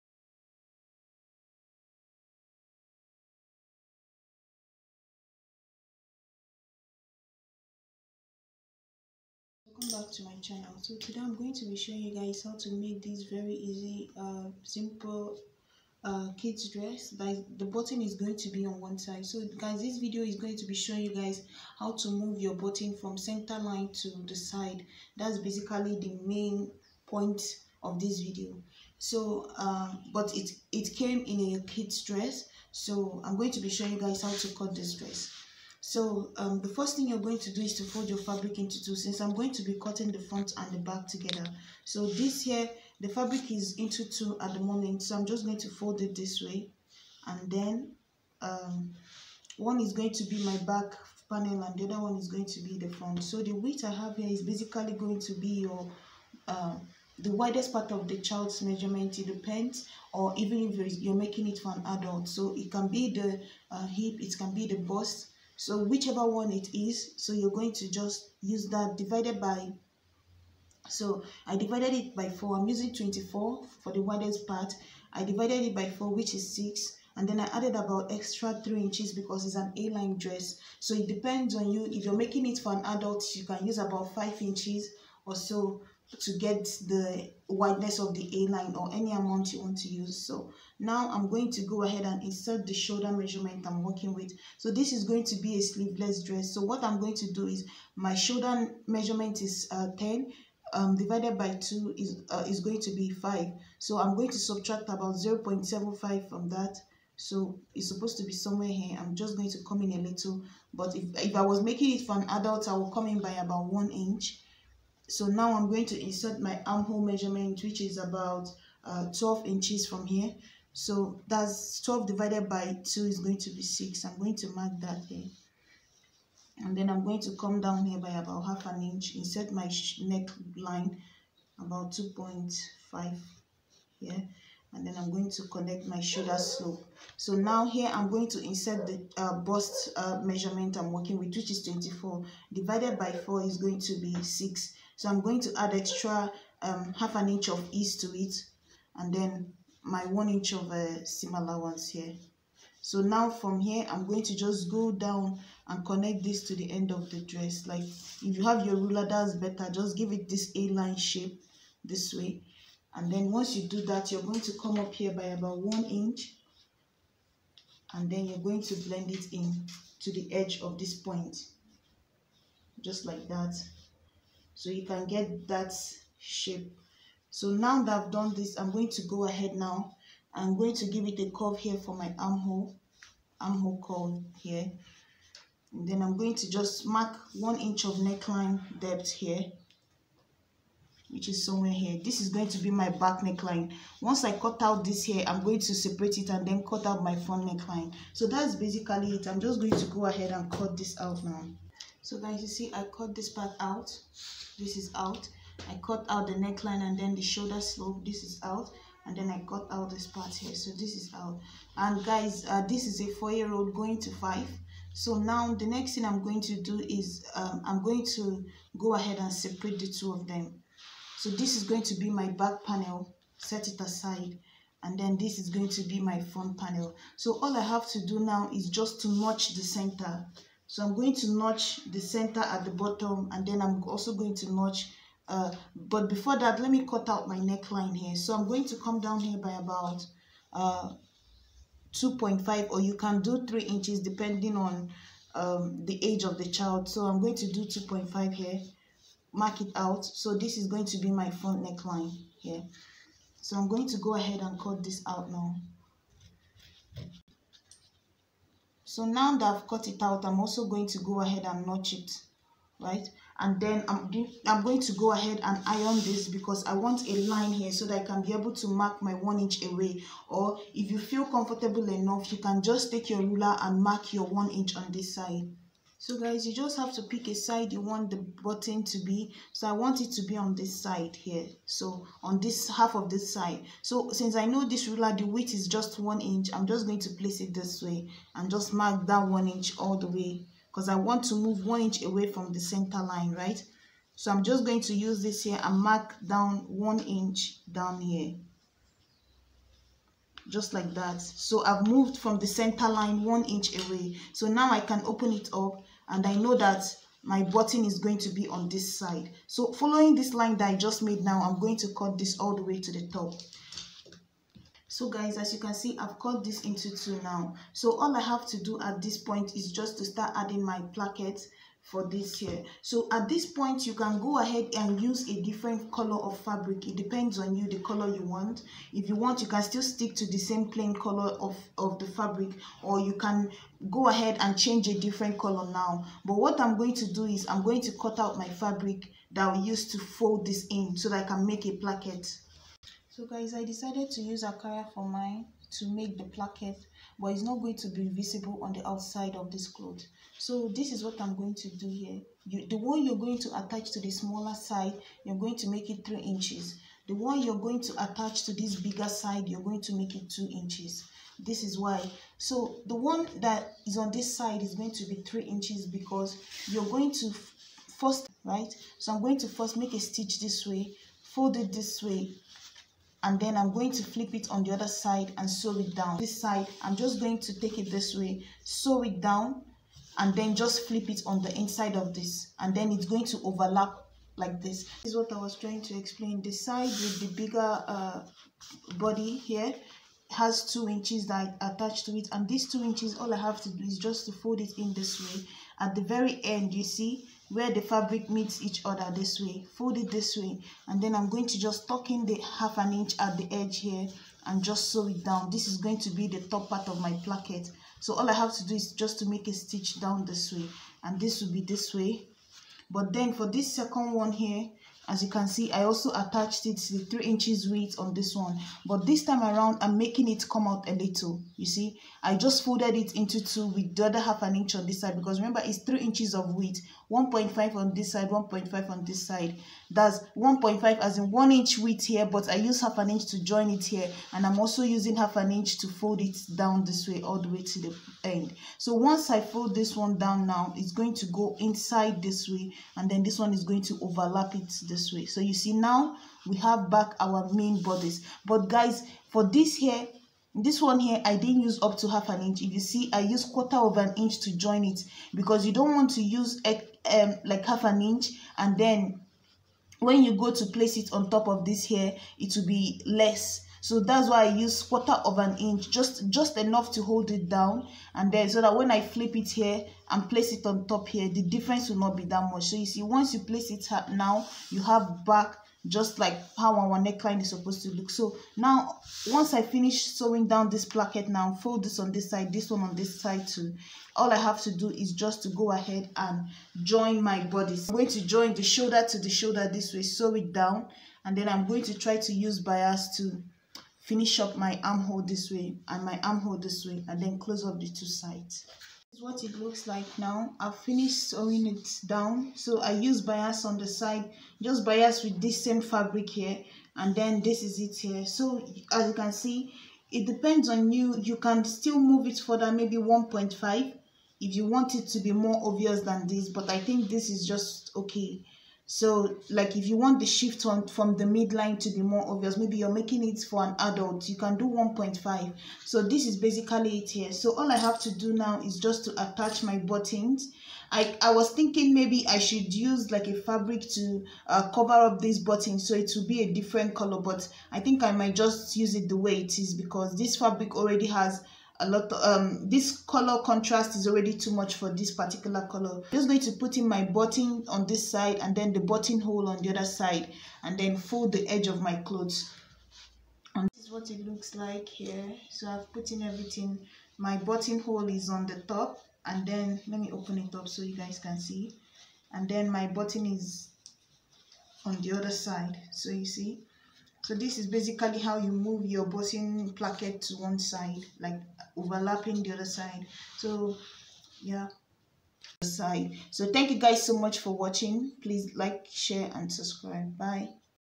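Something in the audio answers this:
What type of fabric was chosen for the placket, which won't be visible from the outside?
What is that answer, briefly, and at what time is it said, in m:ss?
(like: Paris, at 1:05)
Ankara, at 5:44.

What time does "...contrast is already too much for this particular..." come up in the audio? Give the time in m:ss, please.
9:03.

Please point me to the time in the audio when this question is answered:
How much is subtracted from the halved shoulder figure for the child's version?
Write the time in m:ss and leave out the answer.
1:45.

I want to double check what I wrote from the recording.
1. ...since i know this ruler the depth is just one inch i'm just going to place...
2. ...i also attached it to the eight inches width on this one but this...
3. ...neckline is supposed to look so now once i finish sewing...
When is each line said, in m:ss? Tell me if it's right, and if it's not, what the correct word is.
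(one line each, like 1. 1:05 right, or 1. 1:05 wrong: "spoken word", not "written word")
1. 4:44 wrong: "width", not "depth"
2. 6:55 wrong: "three", not "eight"
3. 7:56 right.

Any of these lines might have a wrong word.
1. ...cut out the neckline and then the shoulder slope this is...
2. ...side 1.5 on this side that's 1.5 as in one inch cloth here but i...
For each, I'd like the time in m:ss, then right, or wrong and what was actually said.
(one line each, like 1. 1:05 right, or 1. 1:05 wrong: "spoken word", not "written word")
1. 3:25 right
2. 7:08 wrong: "width", not "cloth".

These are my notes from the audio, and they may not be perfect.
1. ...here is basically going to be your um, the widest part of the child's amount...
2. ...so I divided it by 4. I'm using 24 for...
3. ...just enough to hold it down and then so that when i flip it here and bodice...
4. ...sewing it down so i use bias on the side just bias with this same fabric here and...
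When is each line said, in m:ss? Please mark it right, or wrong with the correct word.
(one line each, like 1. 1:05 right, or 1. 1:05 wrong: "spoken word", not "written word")
1. 0:54 wrong: "measurement", not "amount"
2. 1:10 right
3. 7:46 wrong: "place", not "bodice"
4. 8:21 right.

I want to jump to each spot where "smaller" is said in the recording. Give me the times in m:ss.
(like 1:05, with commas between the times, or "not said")
5:54.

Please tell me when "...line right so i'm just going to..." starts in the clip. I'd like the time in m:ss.
4:52.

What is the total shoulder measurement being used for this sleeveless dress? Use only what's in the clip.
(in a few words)
10.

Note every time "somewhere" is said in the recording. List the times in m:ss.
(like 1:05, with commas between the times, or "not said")
1:48, 3:11.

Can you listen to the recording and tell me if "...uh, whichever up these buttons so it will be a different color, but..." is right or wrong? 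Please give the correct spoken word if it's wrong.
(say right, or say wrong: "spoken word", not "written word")
wrong: "cover", not "whichever".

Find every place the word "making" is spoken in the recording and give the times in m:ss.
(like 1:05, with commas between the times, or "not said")
1:01, 1:22, 1:51, 6:59, 8:42.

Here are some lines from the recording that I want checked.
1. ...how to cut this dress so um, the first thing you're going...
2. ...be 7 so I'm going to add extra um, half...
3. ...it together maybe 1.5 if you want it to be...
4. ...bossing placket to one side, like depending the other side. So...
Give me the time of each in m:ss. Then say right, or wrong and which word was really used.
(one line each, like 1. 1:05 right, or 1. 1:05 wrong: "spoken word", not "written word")
1. 0:34 right
2. 2:23 wrong: "6", not "7"
3. 8:32 wrong: "further", not "together"
4. 9:29 wrong: "overlapping", not "depending".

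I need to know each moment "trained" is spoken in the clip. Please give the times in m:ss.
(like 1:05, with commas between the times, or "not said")
not said.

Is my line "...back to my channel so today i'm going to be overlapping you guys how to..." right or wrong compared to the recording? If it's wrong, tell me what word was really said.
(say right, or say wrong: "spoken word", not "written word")
wrong: "showing", not "overlapping".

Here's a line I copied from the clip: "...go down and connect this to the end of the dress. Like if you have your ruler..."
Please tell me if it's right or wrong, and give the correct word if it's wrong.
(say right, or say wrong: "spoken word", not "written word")
right.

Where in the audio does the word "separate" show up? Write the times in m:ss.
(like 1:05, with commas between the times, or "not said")
3:15, 3:39.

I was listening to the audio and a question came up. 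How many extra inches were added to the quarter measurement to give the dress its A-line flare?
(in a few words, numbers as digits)
3 inches.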